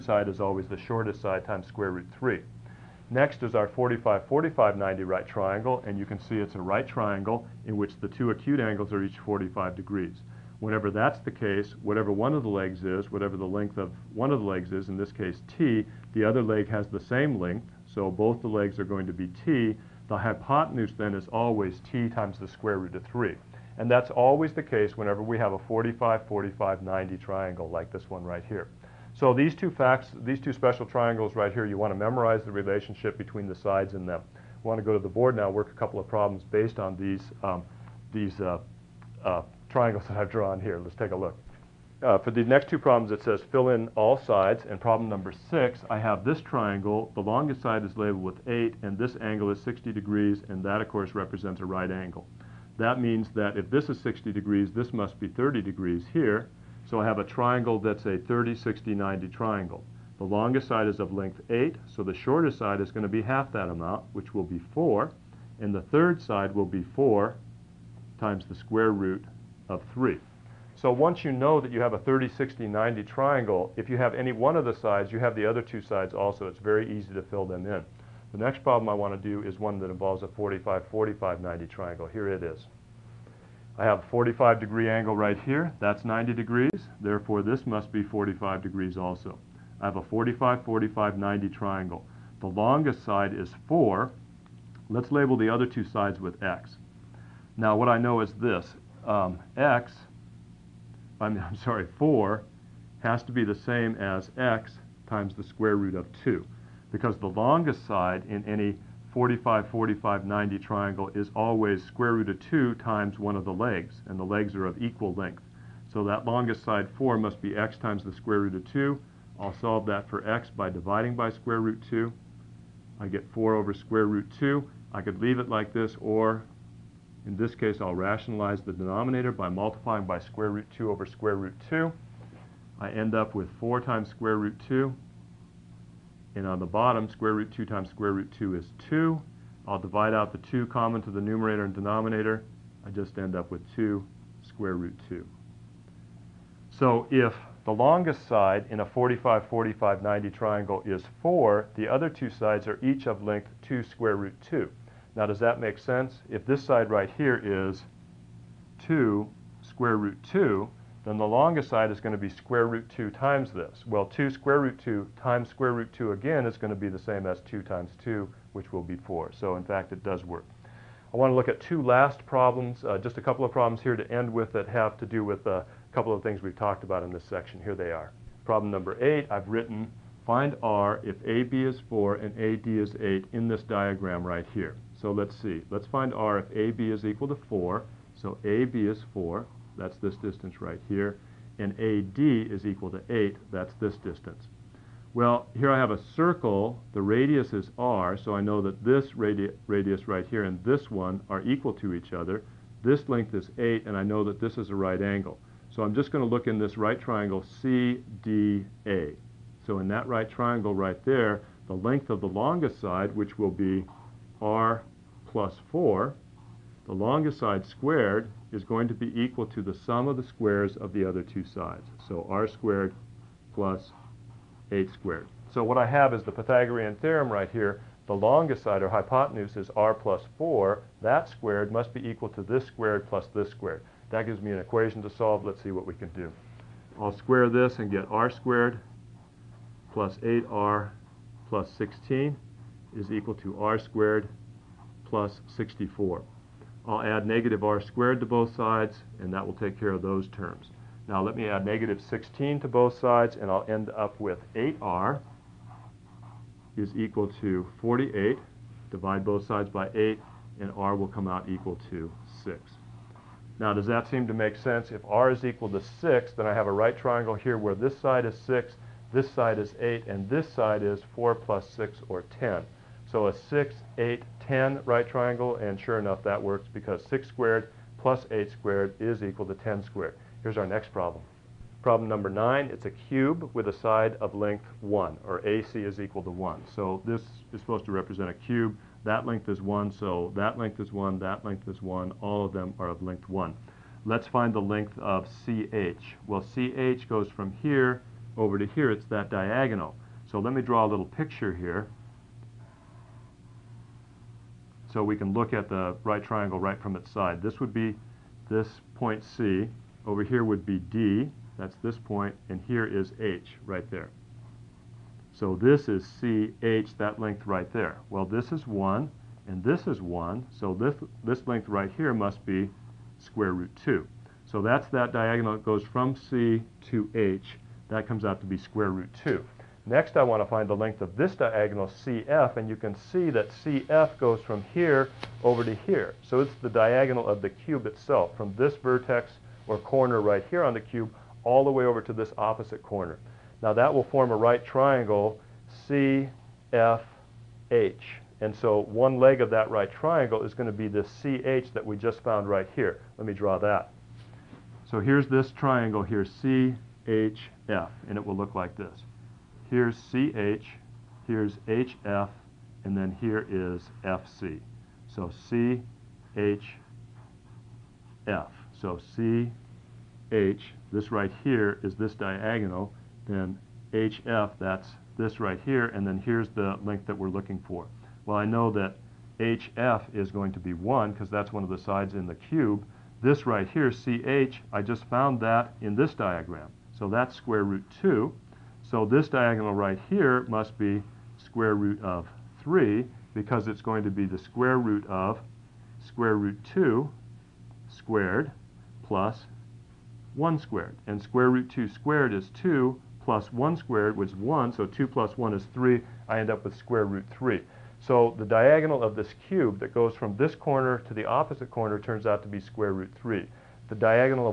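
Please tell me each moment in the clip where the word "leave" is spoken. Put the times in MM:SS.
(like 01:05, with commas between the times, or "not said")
02:05.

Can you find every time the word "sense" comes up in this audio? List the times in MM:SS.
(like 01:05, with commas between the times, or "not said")
02:35, 04:24.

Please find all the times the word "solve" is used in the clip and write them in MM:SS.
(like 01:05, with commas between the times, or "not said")
01:59, 03:55.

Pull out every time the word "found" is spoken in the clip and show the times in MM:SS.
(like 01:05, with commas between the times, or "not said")
05:52, 06:25.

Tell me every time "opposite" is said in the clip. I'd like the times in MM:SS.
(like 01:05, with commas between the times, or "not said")
05:42, 06:51.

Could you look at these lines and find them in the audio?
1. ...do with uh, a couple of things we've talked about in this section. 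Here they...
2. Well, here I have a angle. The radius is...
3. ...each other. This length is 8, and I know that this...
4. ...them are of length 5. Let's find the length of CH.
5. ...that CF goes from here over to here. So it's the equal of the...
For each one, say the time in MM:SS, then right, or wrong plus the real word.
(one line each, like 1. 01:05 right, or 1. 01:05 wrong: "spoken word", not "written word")
1. 02:55 right
2. 03:15 wrong: "circle", not "angle"
3. 03:21 right
4. 04:52 wrong: "1", not "5"
5. 05:33 wrong: "diagonal", not "equal".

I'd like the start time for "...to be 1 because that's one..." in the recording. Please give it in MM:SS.
06:20.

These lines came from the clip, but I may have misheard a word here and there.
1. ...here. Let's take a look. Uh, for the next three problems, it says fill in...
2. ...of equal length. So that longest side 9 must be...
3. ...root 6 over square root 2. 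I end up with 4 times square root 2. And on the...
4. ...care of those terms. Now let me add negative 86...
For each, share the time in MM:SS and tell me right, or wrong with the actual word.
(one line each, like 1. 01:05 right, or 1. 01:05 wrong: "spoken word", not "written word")
1. 00:40 wrong: "two", not "three"
2. 01:54 wrong: "4", not "9"
3. 02:10 wrong: "2", not "6"
4. 04:09 wrong: "16", not "86".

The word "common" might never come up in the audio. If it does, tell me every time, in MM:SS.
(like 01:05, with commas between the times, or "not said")
02:20.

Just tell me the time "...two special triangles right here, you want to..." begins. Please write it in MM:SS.
00:30.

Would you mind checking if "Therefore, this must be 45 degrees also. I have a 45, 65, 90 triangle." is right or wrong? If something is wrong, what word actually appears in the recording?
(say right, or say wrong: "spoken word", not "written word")
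wrong: "45", not "65".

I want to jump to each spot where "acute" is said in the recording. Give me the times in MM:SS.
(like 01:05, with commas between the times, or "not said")
00:08.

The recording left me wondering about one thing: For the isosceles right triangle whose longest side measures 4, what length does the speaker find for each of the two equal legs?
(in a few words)
2 square root 2.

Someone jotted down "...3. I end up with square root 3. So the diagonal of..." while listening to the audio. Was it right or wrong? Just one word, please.
right.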